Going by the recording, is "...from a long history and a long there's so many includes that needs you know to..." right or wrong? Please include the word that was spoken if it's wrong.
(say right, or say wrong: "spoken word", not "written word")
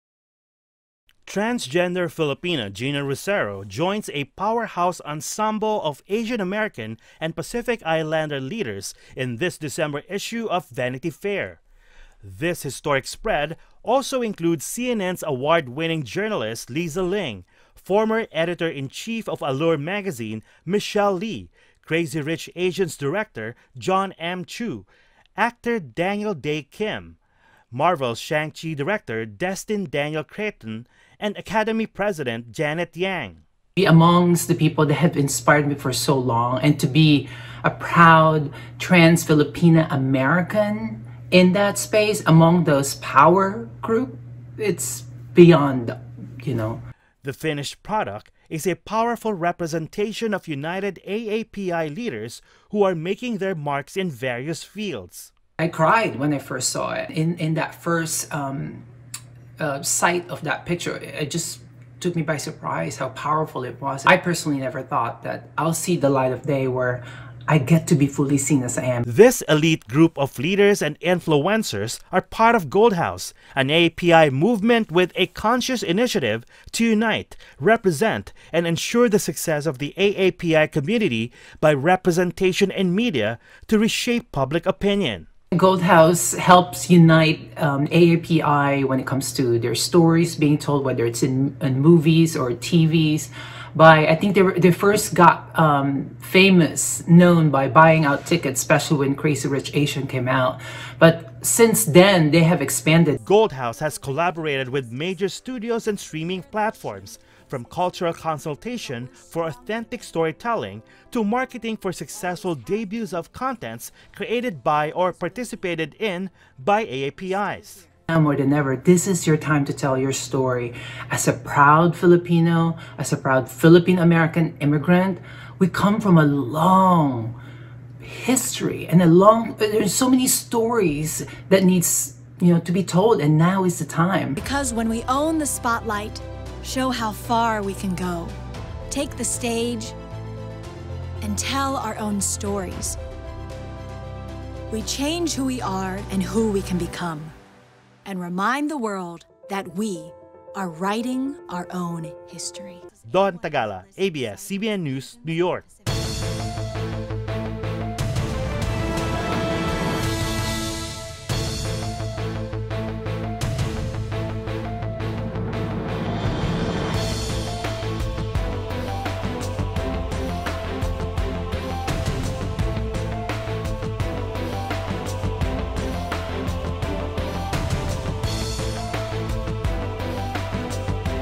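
wrong: "stories", not "includes".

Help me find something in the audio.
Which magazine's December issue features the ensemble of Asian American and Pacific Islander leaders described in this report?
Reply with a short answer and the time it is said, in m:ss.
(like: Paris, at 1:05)
Vanity Fair, at 0:10.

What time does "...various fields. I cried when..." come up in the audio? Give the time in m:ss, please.
0:54.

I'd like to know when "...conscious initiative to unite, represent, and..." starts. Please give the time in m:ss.
1:15.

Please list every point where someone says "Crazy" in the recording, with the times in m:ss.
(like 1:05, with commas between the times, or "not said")
0:21, 1:39.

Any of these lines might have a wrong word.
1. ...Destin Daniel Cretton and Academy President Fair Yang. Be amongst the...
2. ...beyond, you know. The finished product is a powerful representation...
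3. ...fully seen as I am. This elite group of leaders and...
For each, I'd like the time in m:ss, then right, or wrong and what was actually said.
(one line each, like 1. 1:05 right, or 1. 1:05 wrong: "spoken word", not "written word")
1. 0:29 wrong: "Janet", not "Fair"
2. 0:45 right
3. 1:08 right.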